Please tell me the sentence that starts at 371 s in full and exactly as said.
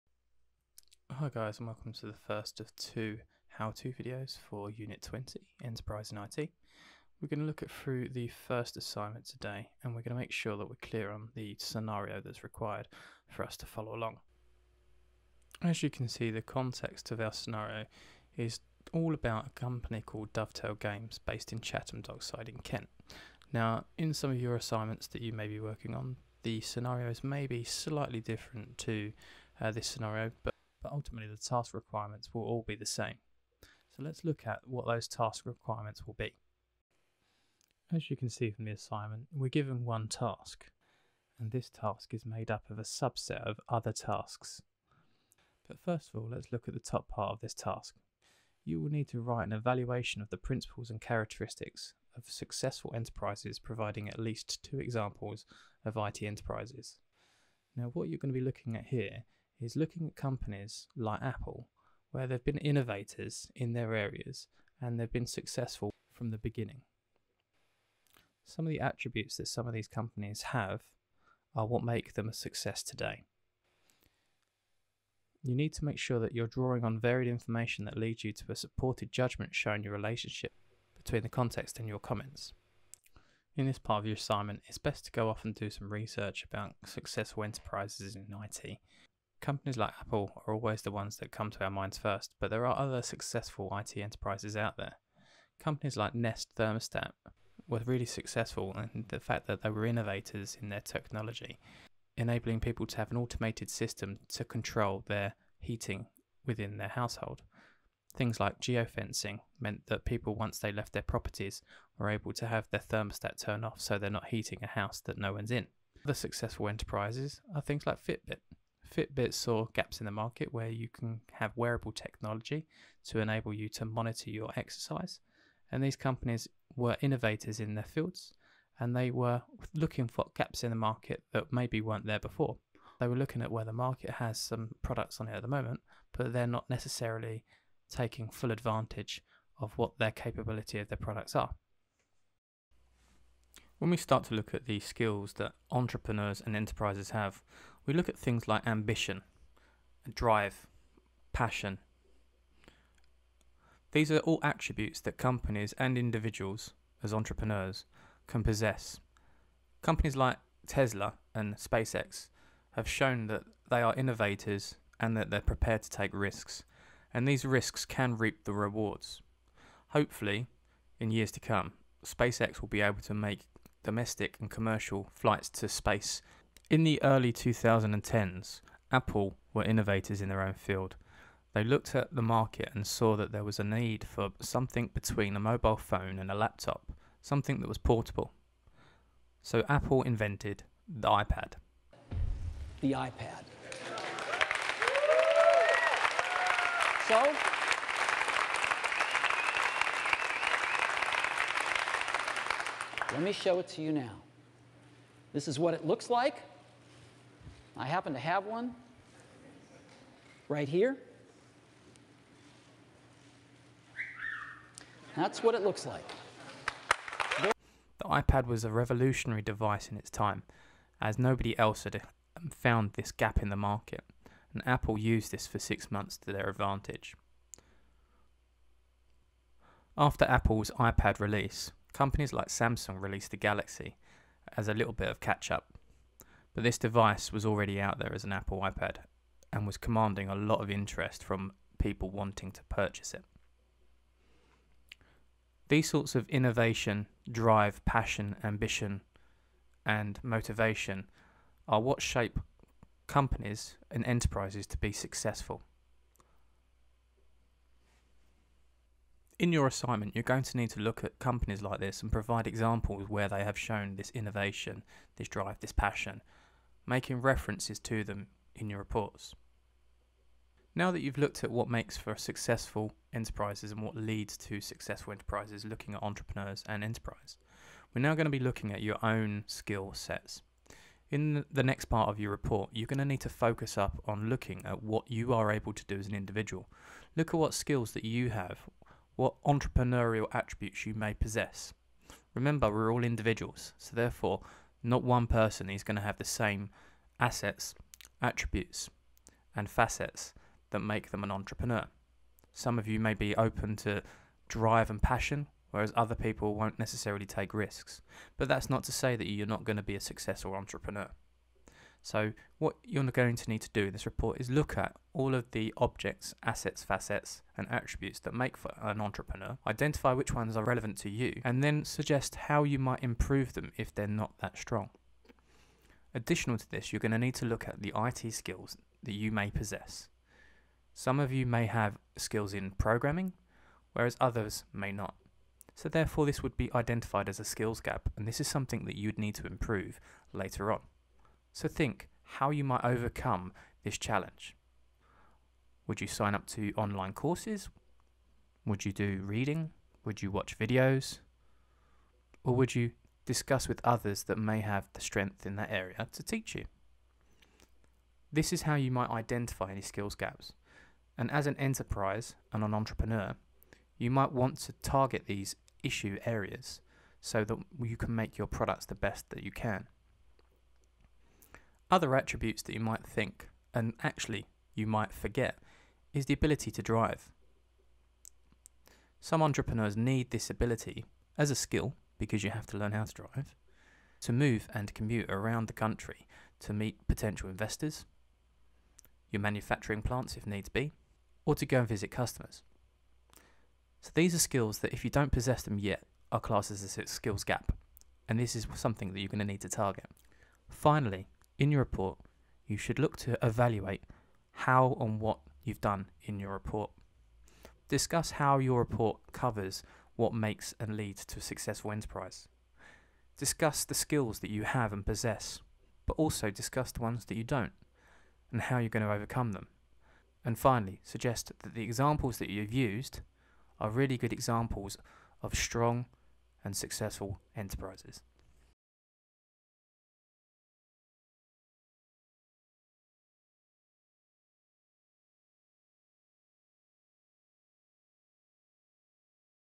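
Other attributes that you might think, and actually you might forget, is the ability to drive.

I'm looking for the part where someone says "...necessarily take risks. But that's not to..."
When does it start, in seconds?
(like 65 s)
306 s.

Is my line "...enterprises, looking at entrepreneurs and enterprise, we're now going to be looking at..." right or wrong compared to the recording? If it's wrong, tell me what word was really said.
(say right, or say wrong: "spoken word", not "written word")
right.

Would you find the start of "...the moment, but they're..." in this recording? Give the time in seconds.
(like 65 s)
135 s.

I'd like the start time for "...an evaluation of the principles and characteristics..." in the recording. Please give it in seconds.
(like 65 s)
49 s.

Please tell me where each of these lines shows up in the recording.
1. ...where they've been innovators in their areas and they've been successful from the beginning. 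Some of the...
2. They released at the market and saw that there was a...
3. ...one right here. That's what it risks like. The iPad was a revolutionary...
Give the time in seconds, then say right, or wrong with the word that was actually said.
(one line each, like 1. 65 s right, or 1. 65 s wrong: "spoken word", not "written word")
1. 62 s right
2. 181 s wrong: "looked", not "released"
3. 208 s wrong: "looks", not "risks".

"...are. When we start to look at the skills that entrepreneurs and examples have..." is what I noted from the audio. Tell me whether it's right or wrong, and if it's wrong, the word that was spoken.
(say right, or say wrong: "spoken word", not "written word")
wrong: "enterprises", not "examples".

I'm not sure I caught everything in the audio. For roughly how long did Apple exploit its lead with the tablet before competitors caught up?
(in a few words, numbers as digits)
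6 months.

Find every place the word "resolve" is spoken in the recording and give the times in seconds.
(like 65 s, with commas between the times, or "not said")
not said.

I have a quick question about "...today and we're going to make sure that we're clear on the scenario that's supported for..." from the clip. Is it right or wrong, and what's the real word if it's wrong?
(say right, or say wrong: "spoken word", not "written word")
wrong: "required", not "supported".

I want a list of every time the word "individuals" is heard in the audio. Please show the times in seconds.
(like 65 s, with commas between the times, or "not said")
155 s, 286 s, 293 s.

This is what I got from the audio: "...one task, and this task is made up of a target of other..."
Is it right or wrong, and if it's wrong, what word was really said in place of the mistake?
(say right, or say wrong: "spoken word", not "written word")
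wrong: "subset", not "target".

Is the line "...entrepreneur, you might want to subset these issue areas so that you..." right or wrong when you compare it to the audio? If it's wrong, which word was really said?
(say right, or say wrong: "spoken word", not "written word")
wrong: "target", not "subset".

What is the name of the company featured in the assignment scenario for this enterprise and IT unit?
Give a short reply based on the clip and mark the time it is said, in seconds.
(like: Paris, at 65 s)
Dovetail Games, at 20 s.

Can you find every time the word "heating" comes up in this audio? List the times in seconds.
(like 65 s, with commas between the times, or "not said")
105 s, 114 s.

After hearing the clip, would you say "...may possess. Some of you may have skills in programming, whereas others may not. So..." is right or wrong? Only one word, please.
right.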